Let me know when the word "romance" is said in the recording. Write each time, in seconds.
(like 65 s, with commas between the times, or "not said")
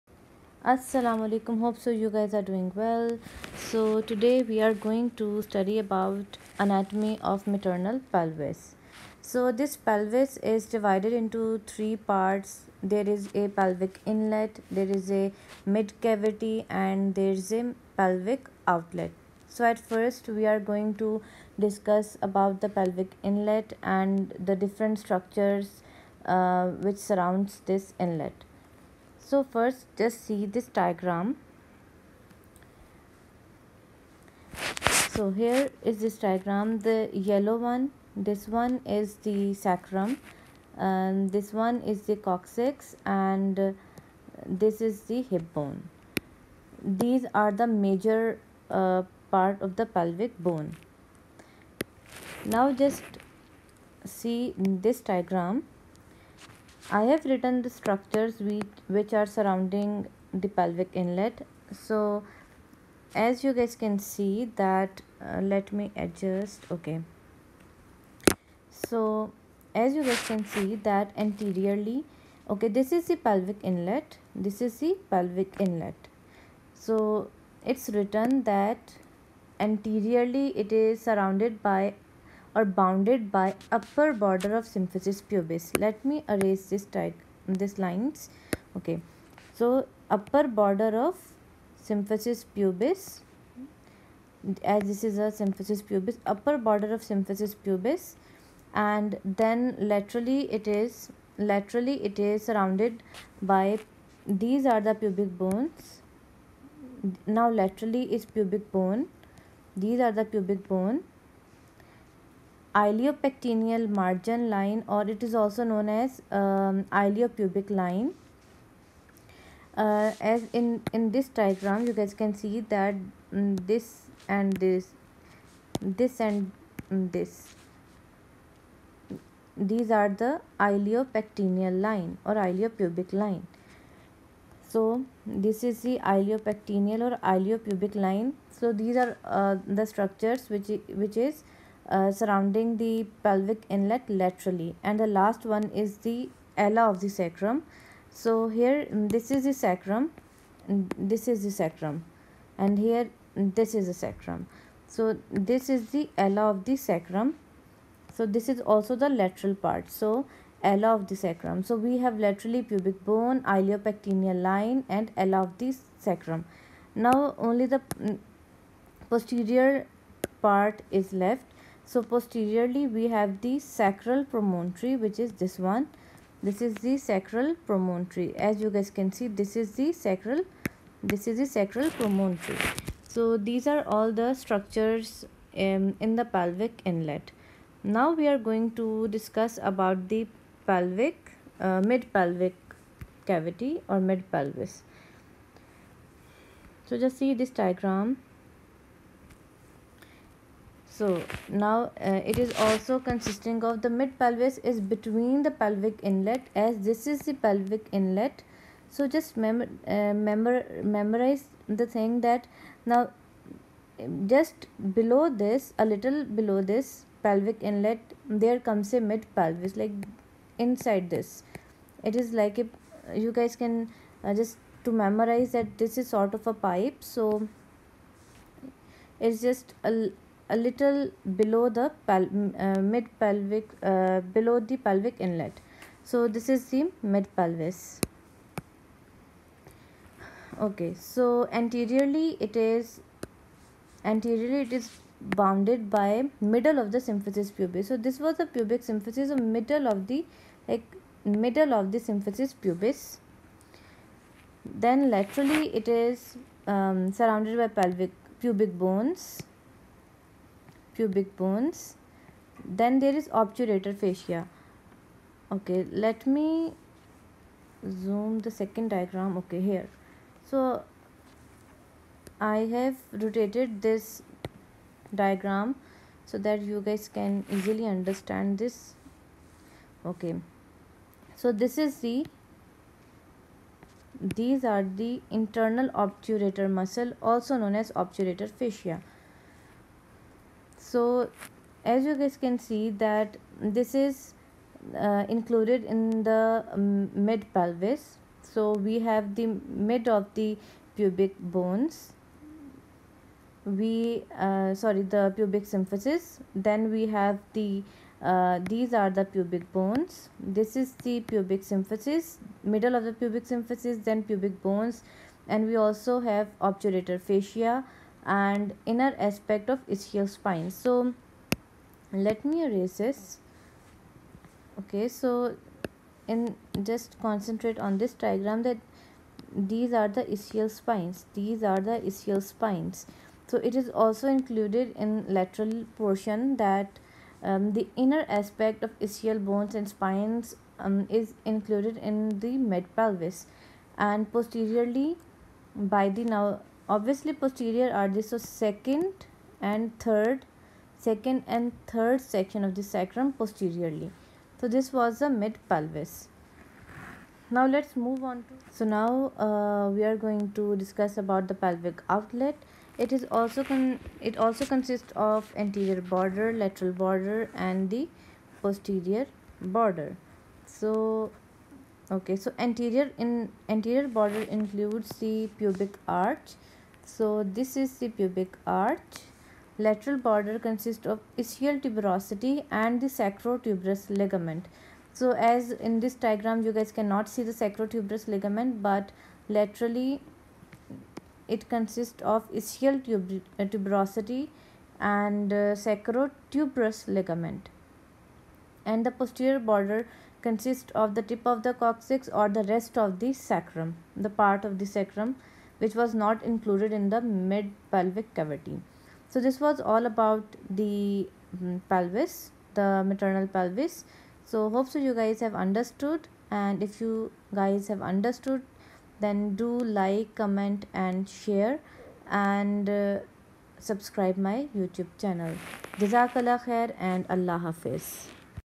not said.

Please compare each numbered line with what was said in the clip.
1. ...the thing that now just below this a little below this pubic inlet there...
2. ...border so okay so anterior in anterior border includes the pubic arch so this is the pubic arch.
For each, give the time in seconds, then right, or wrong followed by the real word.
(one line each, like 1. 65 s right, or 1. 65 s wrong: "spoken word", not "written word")
1. 211 s wrong: "pelvic", not "pubic"
2. 369 s right.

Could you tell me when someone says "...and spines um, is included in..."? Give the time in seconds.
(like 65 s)
339 s.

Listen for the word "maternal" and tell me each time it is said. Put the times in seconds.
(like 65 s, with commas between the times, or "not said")
7 s, 413 s.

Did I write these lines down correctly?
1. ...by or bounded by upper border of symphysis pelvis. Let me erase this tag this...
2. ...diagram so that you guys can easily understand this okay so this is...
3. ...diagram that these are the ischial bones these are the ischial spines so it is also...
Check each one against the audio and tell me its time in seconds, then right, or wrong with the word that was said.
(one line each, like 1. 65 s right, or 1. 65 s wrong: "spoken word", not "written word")
1. 81 s wrong: "pubis", not "pelvis"
2. 275 s right
3. 328 s wrong: "spines", not "bones".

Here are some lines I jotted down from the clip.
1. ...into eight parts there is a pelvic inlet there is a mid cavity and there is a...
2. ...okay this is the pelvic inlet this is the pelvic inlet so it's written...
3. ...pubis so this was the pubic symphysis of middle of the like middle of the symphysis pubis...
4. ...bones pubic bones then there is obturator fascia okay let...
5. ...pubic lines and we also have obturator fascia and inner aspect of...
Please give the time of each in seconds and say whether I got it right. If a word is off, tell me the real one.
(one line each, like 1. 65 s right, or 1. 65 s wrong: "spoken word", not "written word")
1. 11 s wrong: "three", not "eight"
2. 72 s right
3. 247 s right
4. 258 s right
5. 314 s wrong: "bones", not "lines".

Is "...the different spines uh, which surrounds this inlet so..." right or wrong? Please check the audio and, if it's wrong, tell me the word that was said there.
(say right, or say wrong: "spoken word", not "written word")
wrong: "structures", not "spines".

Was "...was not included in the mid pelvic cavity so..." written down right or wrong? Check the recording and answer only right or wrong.
right.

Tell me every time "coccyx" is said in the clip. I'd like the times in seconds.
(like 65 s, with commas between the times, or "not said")
42 s, 401 s.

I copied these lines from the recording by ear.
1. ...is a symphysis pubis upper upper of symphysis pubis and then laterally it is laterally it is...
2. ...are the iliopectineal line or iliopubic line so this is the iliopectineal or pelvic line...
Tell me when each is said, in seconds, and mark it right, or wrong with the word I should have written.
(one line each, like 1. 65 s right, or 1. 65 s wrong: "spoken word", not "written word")
1. 95 s wrong: "border", not "upper"
2. 129 s wrong: "iliopubic", not "pelvic".